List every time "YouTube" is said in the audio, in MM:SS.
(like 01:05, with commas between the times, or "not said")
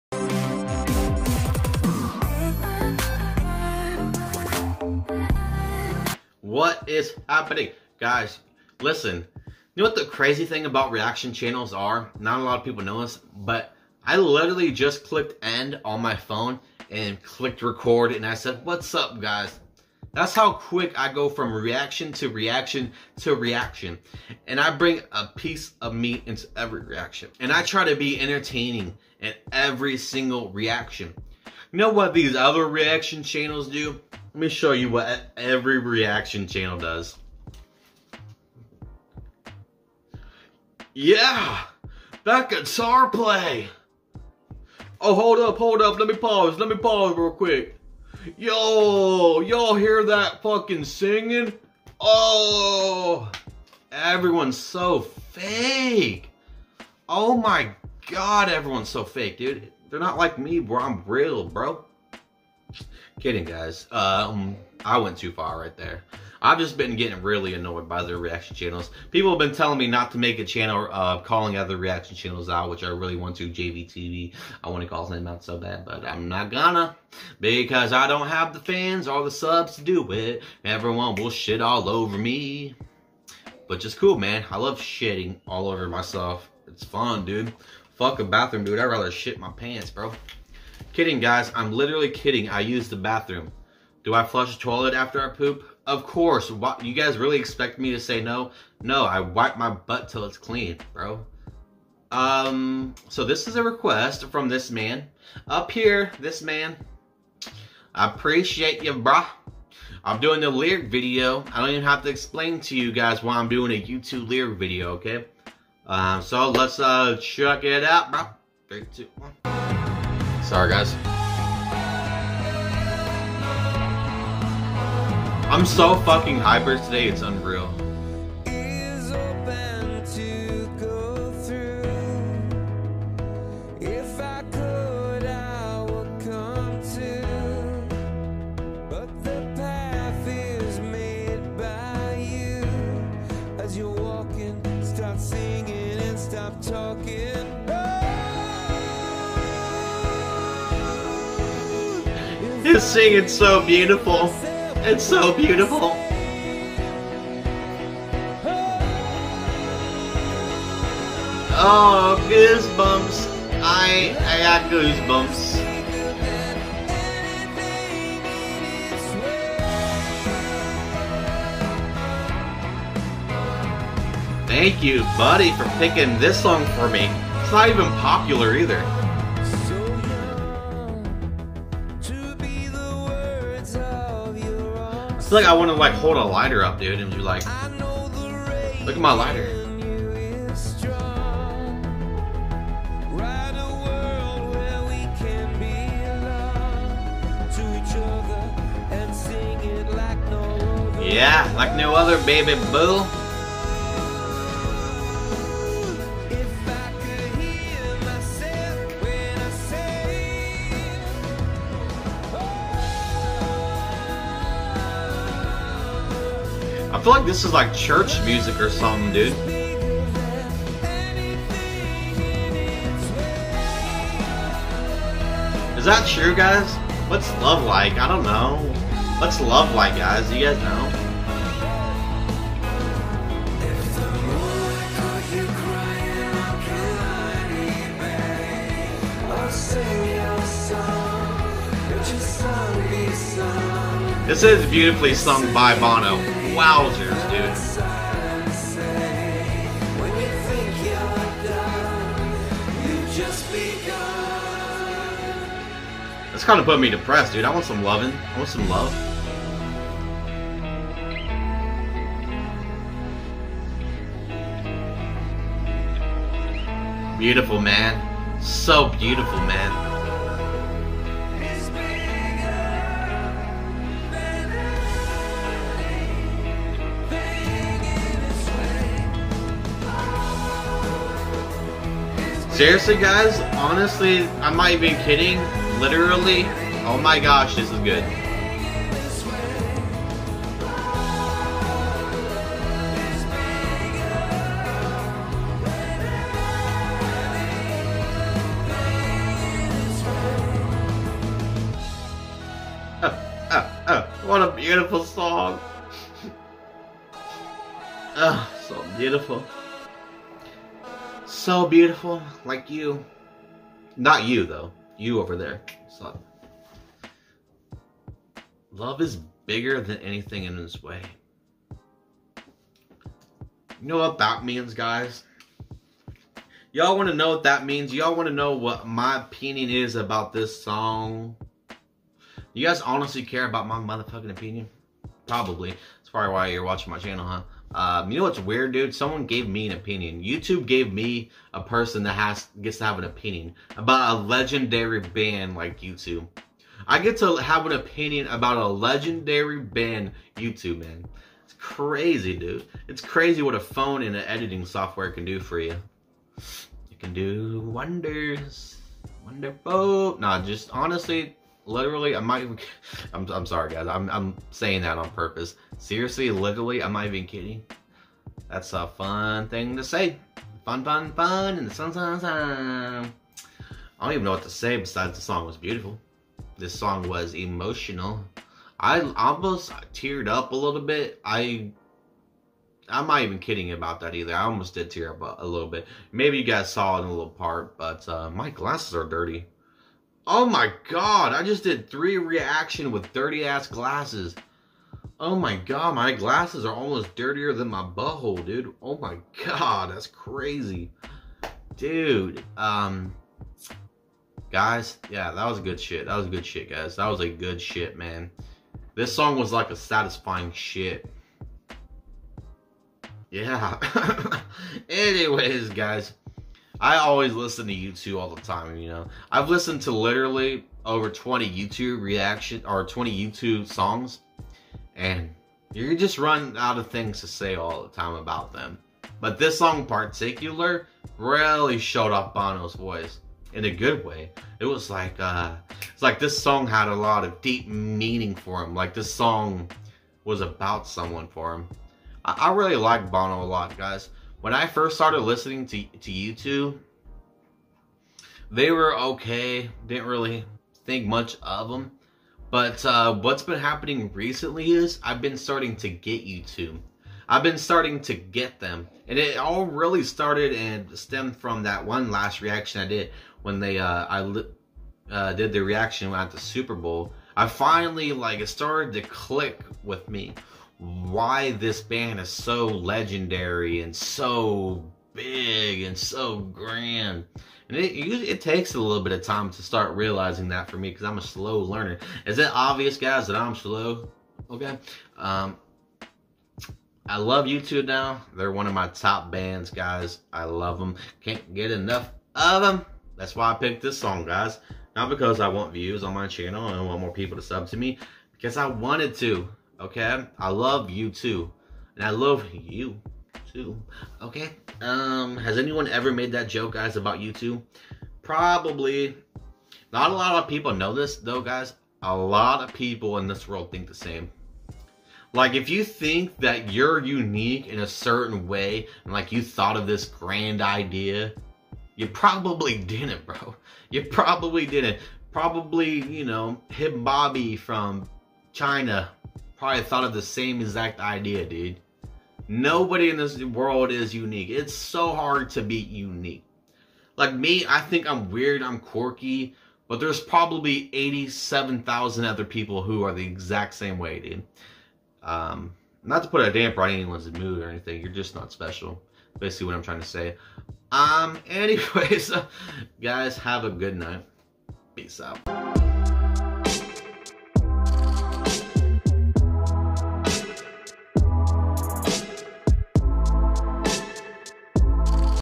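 01:53, 05:40.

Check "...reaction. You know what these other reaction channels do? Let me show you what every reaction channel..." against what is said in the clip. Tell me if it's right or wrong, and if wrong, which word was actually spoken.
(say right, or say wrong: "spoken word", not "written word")
right.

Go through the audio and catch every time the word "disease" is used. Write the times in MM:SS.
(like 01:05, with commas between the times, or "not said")
not said.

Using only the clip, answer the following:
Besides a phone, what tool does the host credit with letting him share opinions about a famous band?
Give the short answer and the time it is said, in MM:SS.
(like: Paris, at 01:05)
Editing software, at 05:54.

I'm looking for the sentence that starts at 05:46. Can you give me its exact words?
I get to have an opinion about a legendary band, U2, man.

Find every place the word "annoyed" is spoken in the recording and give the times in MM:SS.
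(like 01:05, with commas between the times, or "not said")
01:07.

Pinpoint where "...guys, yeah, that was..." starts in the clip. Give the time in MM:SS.
06:44.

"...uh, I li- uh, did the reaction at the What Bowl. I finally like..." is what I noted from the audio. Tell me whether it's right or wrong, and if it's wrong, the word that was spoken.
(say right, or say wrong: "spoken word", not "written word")
wrong: "Super", not "What".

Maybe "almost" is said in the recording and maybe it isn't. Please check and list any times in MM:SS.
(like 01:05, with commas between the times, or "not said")
06:19, 06:24, 06:36.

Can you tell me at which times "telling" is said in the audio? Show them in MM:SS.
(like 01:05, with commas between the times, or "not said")
01:09.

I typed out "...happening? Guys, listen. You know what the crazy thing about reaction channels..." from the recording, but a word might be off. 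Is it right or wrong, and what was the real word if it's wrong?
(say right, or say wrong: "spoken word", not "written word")
right.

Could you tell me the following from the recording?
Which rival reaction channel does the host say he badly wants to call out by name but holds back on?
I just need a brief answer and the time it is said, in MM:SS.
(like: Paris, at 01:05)
JVTV, at 01:13.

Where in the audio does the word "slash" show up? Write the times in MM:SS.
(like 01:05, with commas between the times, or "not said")
not said.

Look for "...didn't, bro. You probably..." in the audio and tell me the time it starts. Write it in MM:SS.
08:42.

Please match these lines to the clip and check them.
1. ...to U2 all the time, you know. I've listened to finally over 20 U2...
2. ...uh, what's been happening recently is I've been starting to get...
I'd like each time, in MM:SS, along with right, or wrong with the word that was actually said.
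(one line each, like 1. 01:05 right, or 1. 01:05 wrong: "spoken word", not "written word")
1. 06:57 wrong: "literally", not "finally"
2. 07:32 right.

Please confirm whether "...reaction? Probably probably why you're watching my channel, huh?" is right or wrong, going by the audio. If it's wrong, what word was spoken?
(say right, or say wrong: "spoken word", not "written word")
wrong: "opinion", not "reaction".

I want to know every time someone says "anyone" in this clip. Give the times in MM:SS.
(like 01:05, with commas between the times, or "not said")
08:25, 09:06.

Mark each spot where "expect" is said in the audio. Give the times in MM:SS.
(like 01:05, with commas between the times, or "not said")
01:37.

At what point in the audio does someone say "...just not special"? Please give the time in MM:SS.
09:08.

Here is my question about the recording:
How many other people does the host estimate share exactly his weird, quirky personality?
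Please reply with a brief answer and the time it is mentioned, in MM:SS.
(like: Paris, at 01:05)
87,000, at 09:00.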